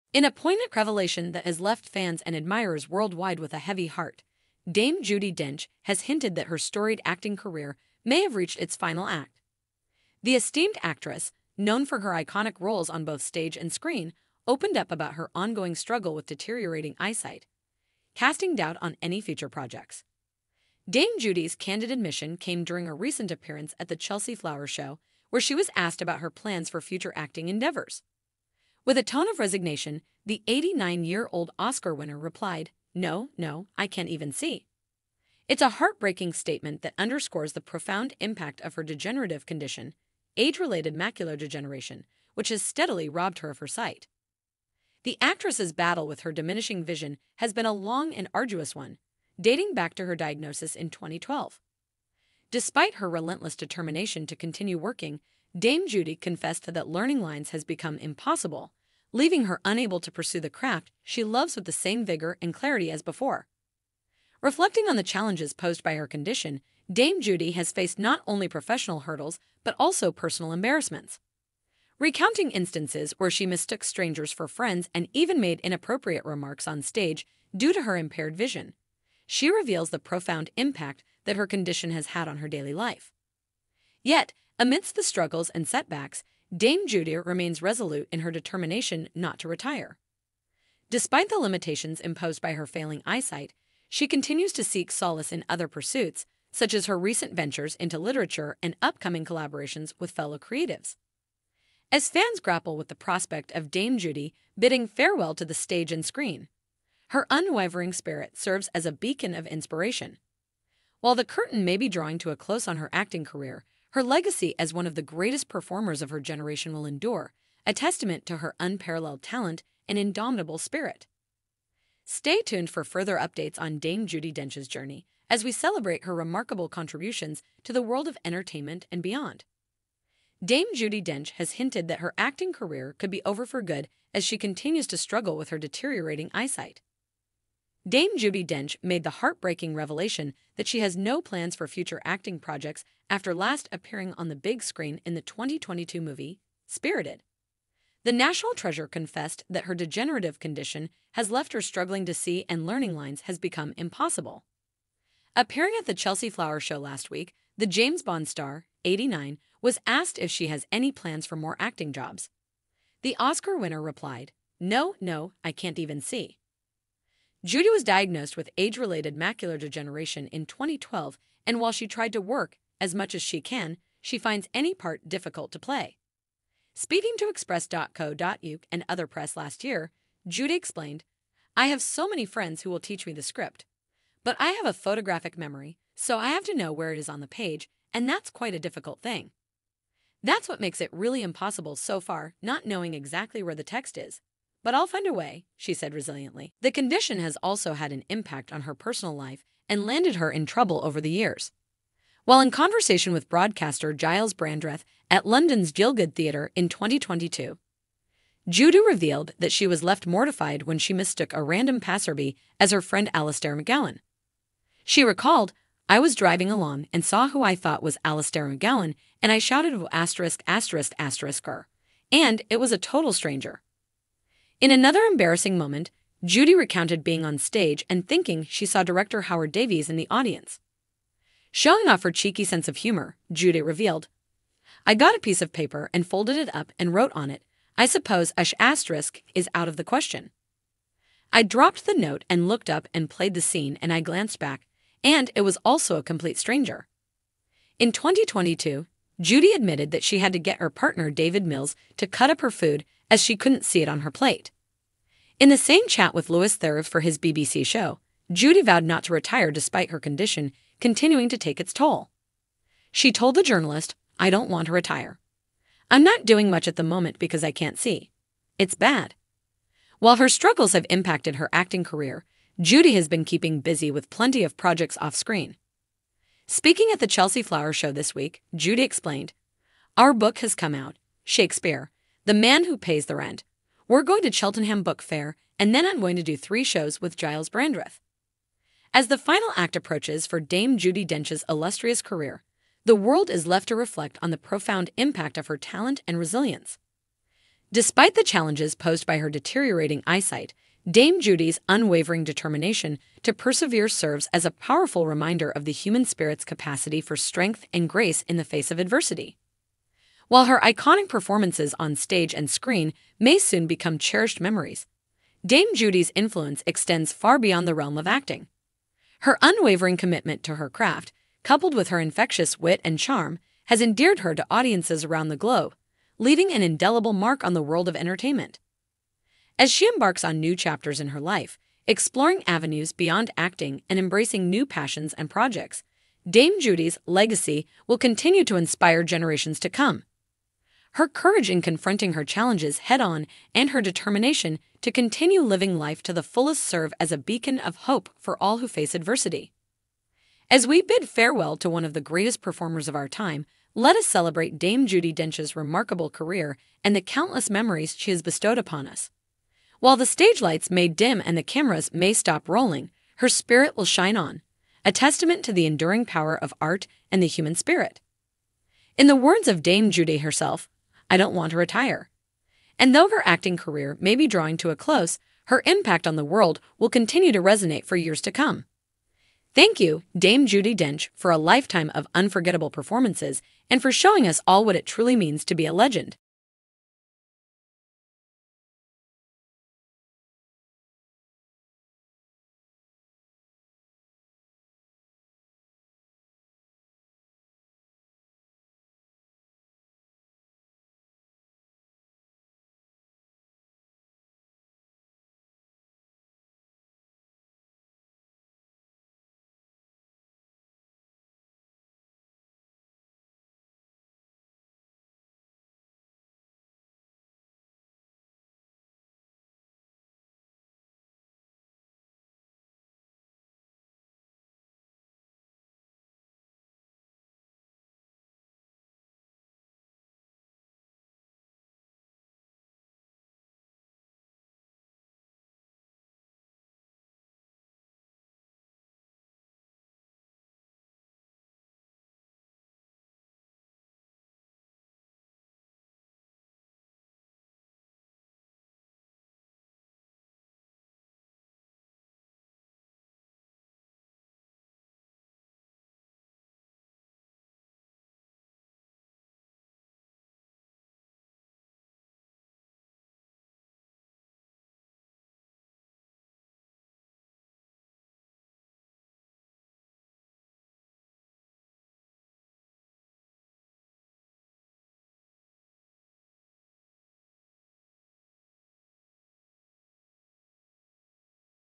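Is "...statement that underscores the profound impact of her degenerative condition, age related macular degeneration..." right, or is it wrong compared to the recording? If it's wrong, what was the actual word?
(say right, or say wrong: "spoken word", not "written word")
right.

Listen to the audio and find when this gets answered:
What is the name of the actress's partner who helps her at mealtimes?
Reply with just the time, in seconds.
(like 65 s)
251 s.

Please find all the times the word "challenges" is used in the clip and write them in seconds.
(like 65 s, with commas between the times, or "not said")
65 s, 298 s, 342 s.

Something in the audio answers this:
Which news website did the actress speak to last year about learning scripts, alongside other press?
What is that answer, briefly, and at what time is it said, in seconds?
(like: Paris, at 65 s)
express.co.uk, at 177 s.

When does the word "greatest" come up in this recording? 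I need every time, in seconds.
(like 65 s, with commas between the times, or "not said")
115 s, 352 s.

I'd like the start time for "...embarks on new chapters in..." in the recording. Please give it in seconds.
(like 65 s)
329 s.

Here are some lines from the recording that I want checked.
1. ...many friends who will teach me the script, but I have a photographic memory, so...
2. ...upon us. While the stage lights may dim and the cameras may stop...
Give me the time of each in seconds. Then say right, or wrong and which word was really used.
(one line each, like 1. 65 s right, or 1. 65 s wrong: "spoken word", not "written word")
1. 182 s right
2. 358 s right.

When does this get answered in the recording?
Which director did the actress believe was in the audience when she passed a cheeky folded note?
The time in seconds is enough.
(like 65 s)
229 s.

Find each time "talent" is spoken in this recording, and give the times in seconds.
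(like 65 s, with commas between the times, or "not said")
119 s, 295 s.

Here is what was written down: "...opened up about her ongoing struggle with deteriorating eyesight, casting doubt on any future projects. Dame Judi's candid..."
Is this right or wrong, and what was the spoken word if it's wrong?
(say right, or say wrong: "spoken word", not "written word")
right.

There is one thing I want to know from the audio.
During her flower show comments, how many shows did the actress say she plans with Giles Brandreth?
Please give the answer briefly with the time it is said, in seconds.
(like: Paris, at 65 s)
3, at 286 s.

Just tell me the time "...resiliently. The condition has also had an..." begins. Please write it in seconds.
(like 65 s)
195 s.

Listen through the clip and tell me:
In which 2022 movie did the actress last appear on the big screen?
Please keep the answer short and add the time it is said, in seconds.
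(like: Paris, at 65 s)
Spirited, at 146 s.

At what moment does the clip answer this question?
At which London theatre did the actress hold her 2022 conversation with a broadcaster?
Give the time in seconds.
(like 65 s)
205 s.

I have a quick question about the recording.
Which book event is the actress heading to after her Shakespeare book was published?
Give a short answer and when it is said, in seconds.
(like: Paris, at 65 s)
Cheltenham Book Fair, at 284 s.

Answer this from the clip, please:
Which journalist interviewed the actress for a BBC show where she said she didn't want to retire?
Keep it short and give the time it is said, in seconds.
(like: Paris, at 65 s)
Louis Theroux, at 256 s.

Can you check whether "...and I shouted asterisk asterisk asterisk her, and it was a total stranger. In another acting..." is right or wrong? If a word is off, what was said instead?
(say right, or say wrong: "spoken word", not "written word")
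wrong: "embarrassing", not "acting".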